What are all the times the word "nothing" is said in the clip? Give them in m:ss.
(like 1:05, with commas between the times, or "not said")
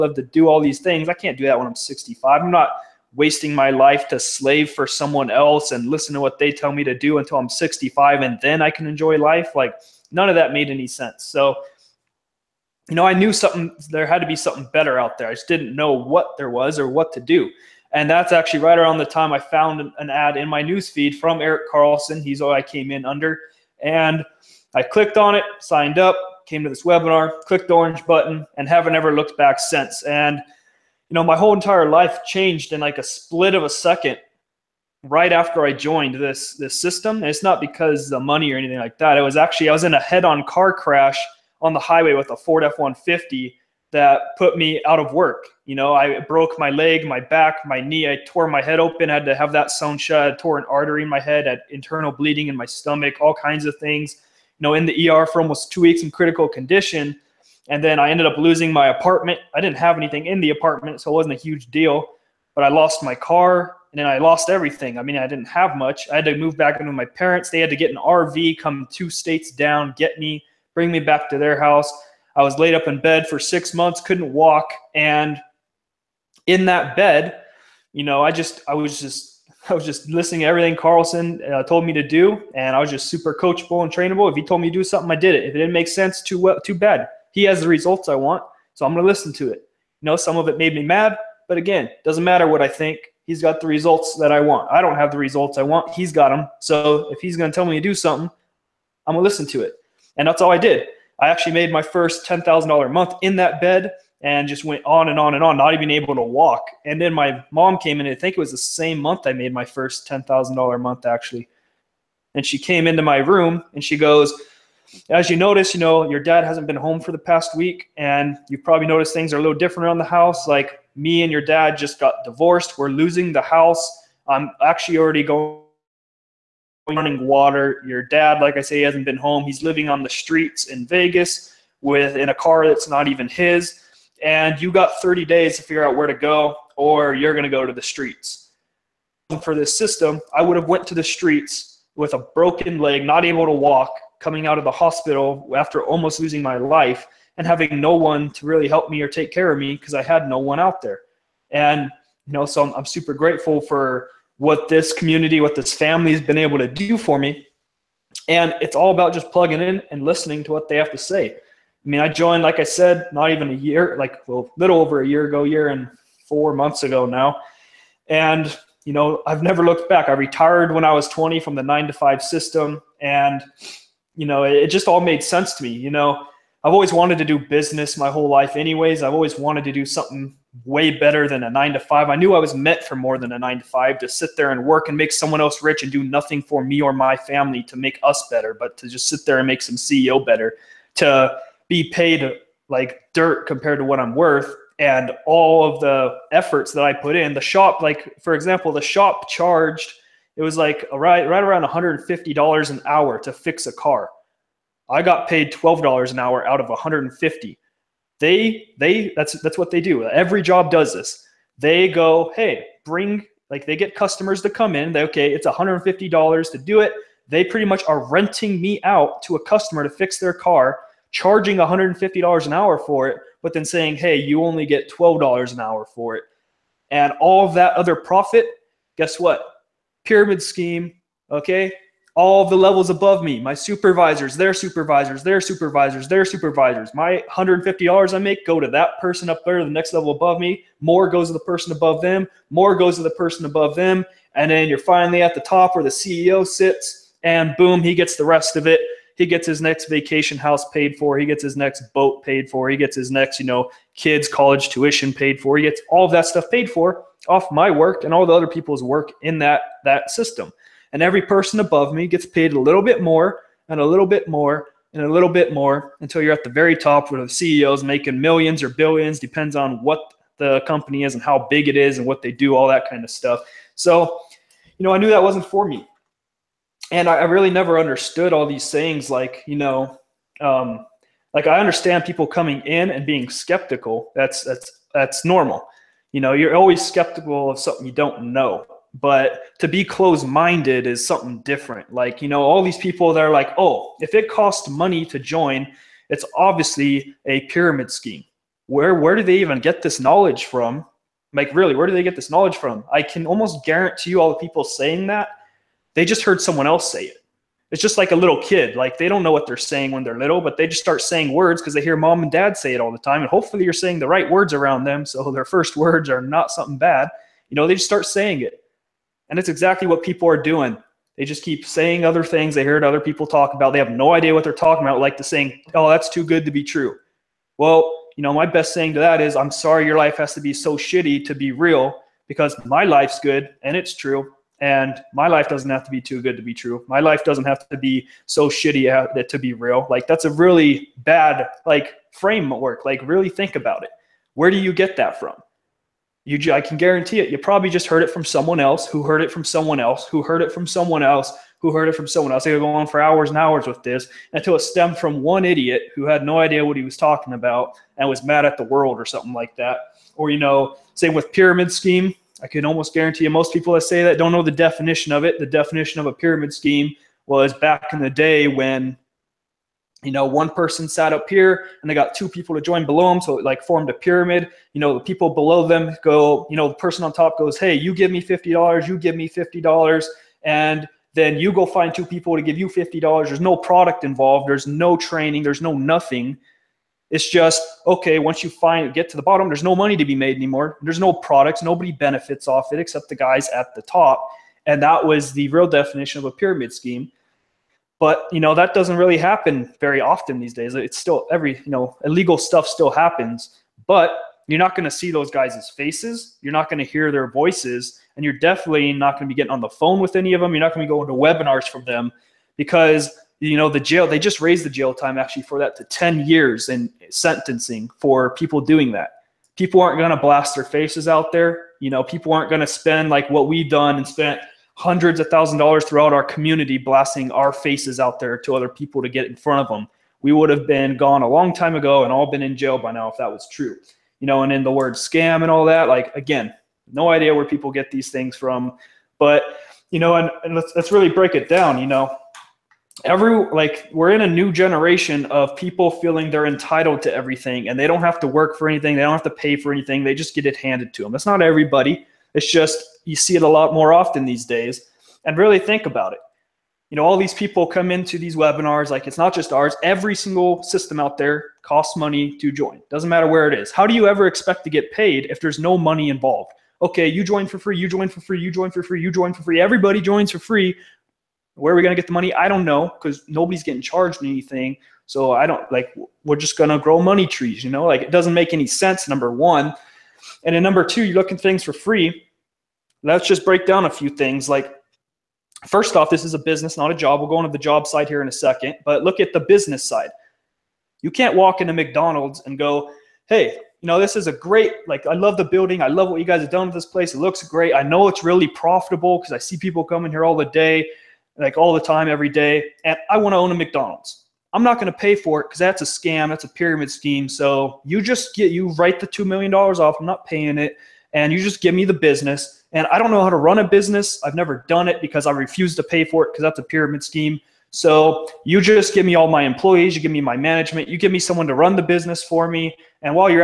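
3:06, 6:25.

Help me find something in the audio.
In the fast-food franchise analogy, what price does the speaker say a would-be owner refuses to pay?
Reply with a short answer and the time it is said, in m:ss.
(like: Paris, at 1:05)
$2 million, at 8:29.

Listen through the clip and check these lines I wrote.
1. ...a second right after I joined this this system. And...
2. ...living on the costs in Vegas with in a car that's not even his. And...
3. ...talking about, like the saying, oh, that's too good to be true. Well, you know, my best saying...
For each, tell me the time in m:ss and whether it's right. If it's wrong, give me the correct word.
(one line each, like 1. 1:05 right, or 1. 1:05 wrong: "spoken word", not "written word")
1. 0:33 right
2. 2:09 wrong: "streets", not "costs"
3. 5:24 right.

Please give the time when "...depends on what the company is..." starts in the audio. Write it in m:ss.
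4:29.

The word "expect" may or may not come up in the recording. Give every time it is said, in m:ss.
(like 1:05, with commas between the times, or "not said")
7:44.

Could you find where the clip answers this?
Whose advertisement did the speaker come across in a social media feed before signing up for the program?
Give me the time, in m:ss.
0:21.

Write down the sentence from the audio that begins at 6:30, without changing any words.
There's no products, nobody benefits off it except the guys at the top.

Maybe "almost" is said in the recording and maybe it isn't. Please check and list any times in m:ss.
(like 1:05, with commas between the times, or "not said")
0:55, 2:25, 5:03, 6:02.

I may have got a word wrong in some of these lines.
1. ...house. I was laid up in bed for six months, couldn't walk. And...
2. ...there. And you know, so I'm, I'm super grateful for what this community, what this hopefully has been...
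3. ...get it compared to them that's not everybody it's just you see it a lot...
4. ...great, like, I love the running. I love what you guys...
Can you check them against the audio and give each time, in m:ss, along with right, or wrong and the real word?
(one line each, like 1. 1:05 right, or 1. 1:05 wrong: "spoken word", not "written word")
1. 1:11 right
2. 2:30 wrong: "family", not "hopefully"
3. 7:30 wrong: "handed", not "compared"
4. 8:14 wrong: "building", not "running".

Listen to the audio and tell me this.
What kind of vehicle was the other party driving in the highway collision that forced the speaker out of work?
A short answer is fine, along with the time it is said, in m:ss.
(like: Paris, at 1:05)
Ford F-150, at 0:42.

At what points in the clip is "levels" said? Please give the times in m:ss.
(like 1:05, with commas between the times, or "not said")
3:52, 3:59.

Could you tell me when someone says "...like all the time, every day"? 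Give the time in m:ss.
8:21.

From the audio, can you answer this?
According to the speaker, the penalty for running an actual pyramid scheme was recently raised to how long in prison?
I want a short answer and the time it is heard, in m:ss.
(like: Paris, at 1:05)
10 years, at 6:55.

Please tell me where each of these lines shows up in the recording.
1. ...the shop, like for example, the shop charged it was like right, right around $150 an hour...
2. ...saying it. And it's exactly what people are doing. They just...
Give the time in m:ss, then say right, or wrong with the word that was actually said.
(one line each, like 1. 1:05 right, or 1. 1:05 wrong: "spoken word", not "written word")
1. 3:17 right
2. 5:18 right.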